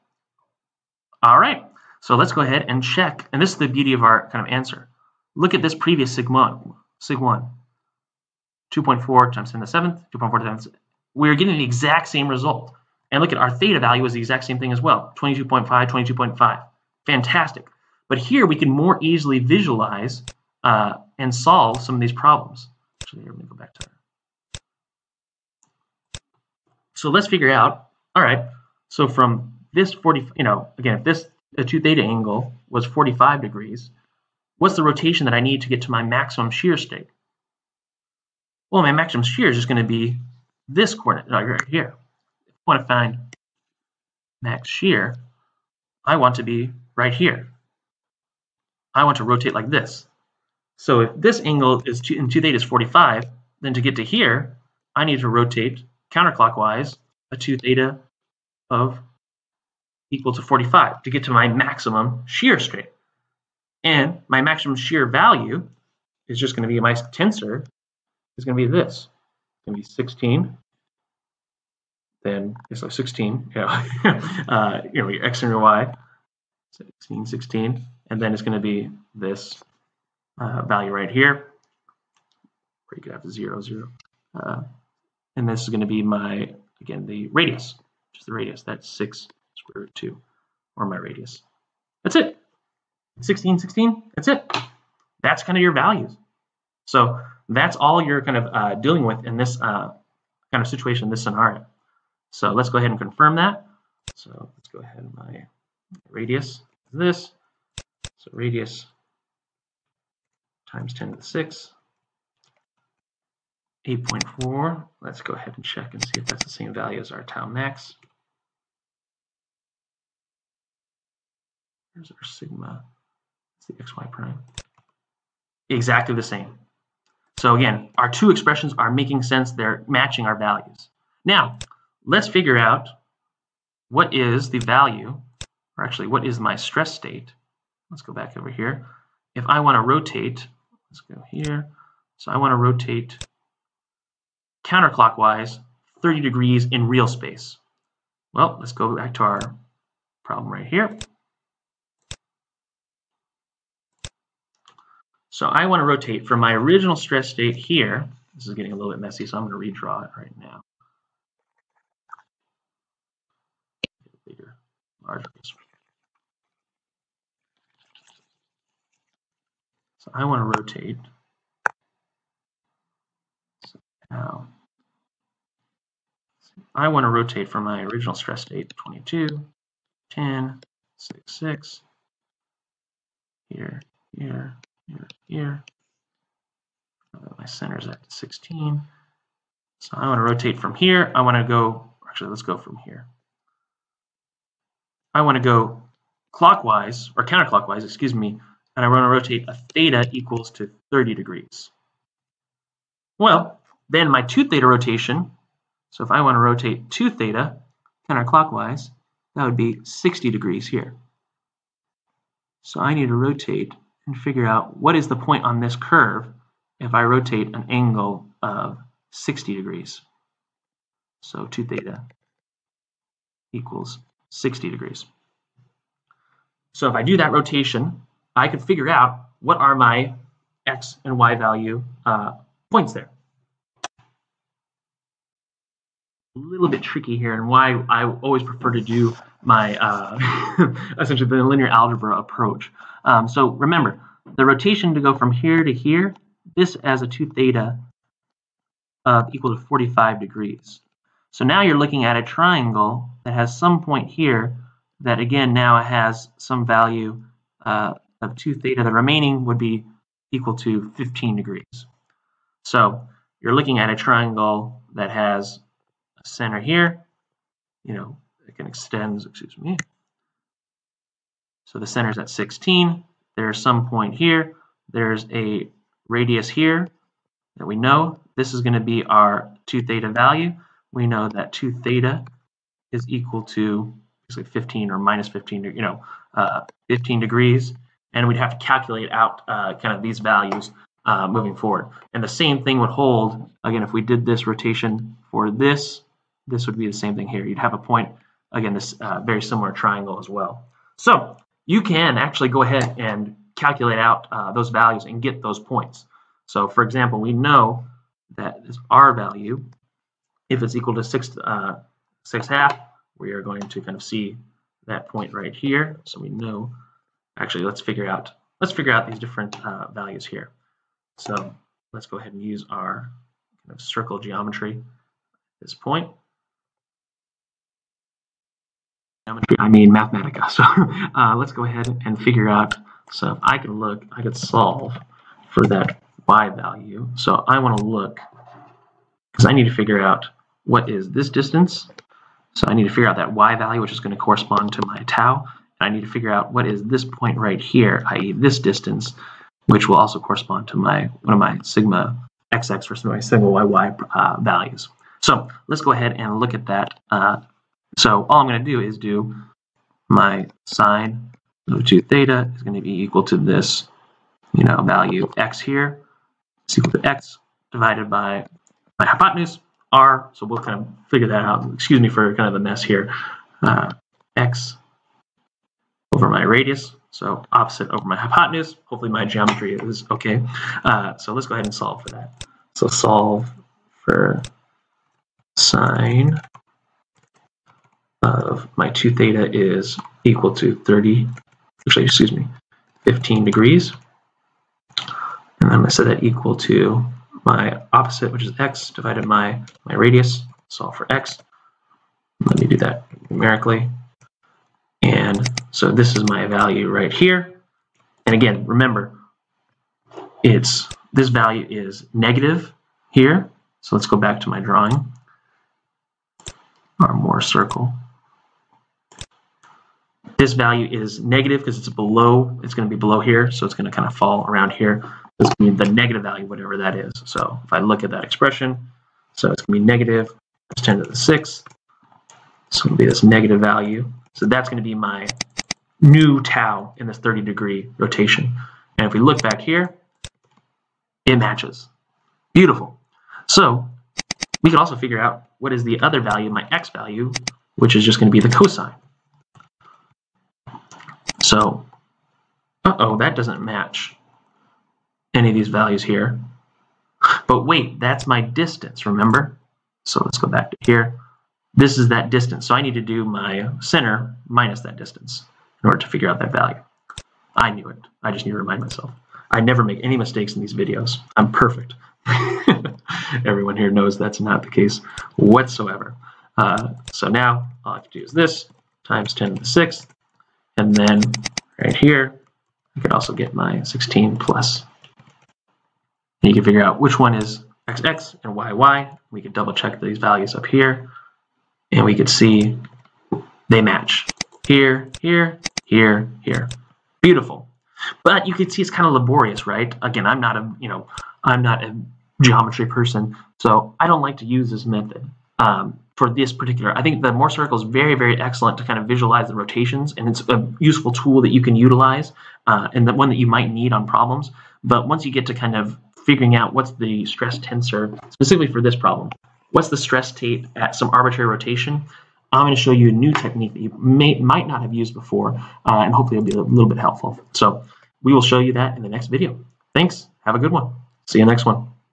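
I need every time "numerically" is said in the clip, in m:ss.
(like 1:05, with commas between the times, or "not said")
6:43.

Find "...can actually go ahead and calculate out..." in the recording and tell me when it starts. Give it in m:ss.
5:01.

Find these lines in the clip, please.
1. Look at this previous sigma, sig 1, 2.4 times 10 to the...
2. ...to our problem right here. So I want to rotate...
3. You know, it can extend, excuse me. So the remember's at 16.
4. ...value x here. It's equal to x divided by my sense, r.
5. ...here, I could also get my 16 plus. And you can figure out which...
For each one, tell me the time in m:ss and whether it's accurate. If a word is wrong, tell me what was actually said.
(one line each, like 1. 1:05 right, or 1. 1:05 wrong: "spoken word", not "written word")
1. 0:05 right
2. 2:29 right
3. 4:27 wrong: "center", not "remember"
4. 6:04 wrong: "hypotenuse", not "sense"
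5. 8:01 right.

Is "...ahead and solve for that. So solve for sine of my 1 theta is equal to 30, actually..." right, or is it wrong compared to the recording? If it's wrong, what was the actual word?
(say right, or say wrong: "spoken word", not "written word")
wrong: "2", not "1".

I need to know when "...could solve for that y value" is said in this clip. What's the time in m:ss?
5:34.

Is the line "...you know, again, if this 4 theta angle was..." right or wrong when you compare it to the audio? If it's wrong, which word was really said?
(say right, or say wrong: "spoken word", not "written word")
wrong: "2", not "4".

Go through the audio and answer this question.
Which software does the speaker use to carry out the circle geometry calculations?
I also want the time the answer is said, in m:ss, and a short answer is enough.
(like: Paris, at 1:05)
Mathematica, at 5:29.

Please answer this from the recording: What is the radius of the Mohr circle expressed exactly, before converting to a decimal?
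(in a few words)
6 square root 2.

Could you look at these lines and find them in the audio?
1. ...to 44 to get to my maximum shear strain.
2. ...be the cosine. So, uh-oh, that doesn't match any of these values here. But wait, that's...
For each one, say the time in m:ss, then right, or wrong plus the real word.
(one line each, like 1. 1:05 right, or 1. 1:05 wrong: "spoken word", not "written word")
1. 1:00 wrong: "45", not "44"
2. 7:28 right.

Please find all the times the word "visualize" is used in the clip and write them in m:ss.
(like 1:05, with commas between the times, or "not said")
0:19, 8:29.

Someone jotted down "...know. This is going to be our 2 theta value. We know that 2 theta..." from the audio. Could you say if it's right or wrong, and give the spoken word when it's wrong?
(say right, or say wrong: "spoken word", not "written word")
right.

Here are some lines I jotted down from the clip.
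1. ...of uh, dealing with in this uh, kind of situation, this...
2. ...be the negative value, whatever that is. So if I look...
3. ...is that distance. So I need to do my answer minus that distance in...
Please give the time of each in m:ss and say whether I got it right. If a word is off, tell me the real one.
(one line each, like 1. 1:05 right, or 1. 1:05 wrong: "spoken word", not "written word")
1. 1:38 right
2. 7:05 right
3. 7:41 wrong: "center", not "answer".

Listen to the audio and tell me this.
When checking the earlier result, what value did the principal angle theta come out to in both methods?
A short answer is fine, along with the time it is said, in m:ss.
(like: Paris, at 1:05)
22.5, at 0:15.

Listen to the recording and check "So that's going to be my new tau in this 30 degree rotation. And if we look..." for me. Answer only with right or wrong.
right.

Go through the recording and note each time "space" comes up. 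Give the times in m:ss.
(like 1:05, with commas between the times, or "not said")
2:27.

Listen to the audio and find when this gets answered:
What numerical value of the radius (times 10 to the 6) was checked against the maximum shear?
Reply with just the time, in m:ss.
1:53.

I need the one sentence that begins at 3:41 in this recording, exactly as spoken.
So 2 theta equals 60 degrees.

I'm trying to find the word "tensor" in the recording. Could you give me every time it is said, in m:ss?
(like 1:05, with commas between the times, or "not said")
1:06, 8:37.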